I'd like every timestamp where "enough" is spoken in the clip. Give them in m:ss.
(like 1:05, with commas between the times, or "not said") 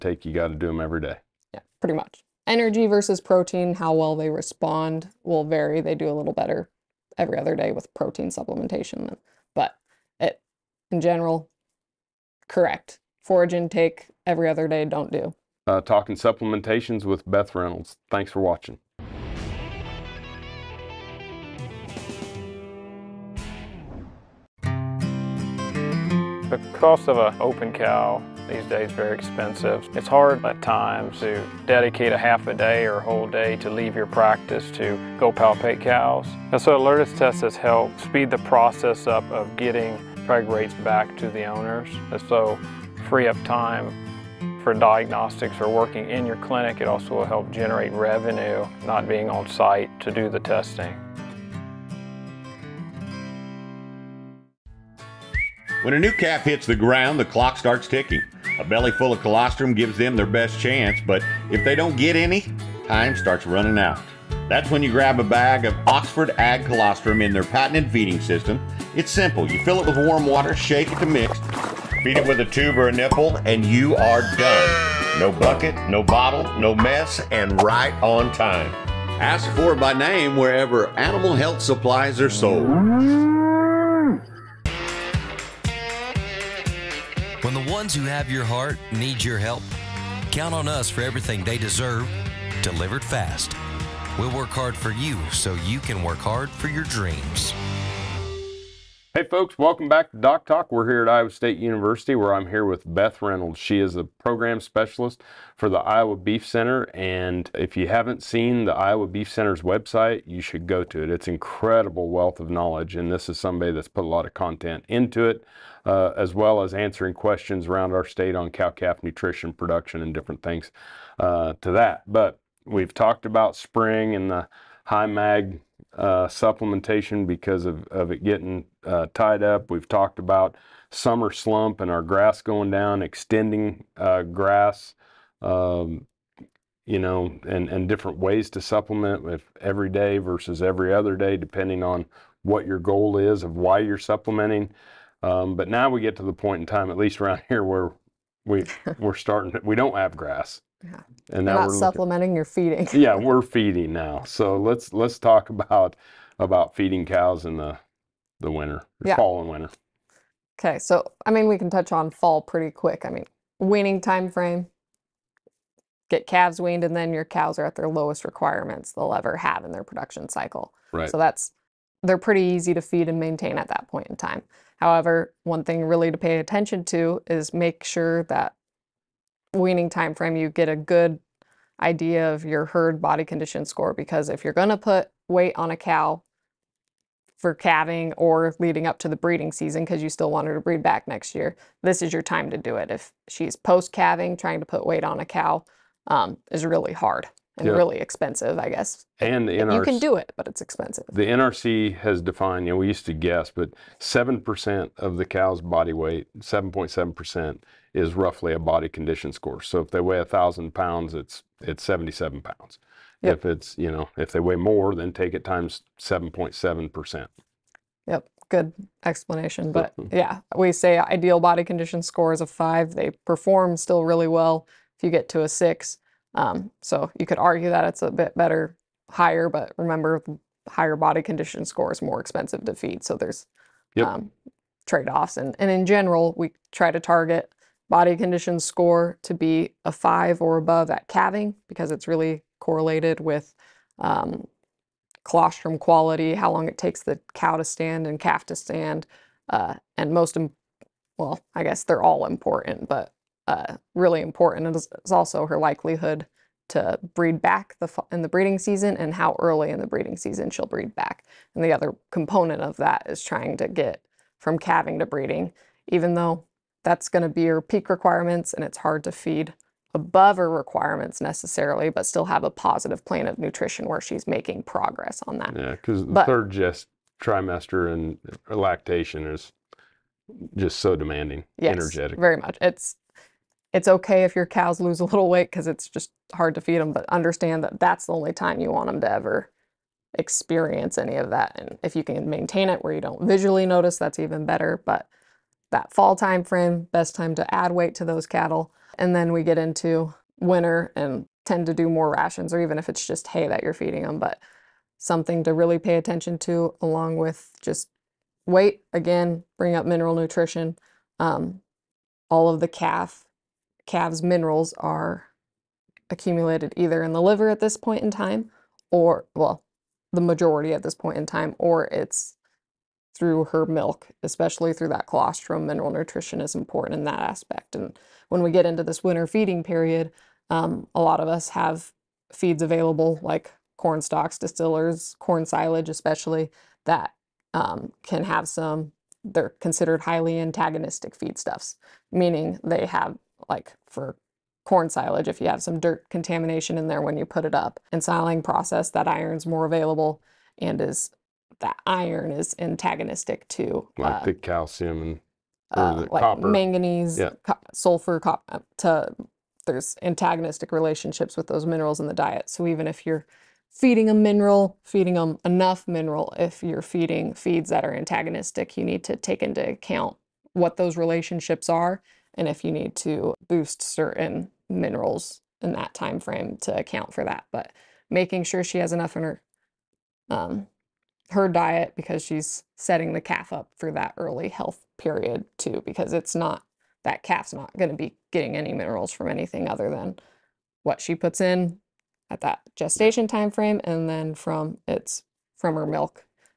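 6:05, 6:18.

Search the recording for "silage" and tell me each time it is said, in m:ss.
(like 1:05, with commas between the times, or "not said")
5:35, 5:44.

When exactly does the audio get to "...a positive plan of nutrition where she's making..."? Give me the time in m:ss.
4:32.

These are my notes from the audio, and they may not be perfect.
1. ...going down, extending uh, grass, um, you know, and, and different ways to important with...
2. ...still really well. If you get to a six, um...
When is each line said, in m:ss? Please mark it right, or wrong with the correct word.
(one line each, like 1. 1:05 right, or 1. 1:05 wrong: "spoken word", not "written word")
1. 2:12 wrong: "supplement", not "important"
2. 3:43 right.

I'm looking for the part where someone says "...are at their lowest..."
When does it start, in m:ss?
2:47.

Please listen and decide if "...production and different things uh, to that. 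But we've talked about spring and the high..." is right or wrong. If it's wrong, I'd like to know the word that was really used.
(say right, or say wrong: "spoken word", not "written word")
right.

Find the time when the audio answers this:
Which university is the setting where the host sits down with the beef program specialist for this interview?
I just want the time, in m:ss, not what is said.
1:41.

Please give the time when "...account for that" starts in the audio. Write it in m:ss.
6:16.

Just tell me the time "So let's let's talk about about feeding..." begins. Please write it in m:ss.
2:34.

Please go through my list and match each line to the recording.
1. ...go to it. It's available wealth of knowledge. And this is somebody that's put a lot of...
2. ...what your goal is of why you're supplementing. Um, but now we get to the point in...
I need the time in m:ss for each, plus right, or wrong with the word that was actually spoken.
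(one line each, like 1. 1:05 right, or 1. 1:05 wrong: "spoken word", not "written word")
1. 1:50 wrong: "incredible", not "available"
2. 2:22 right.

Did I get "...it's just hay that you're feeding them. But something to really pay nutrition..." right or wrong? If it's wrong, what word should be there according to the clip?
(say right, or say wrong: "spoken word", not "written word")
wrong: "attention", not "nutrition".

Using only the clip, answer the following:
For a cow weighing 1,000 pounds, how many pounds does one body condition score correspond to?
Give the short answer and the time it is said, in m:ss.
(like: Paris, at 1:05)
77 pounds, at 3:31.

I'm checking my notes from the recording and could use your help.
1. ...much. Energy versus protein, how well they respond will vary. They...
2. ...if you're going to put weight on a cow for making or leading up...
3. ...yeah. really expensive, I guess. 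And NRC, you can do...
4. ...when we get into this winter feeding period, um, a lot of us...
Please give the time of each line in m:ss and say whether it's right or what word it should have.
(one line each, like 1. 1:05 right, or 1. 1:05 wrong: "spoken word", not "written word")
1. 0:01 right
2. 3:04 wrong: "calving", not "making"
3. 3:17 right
4. 5:28 right.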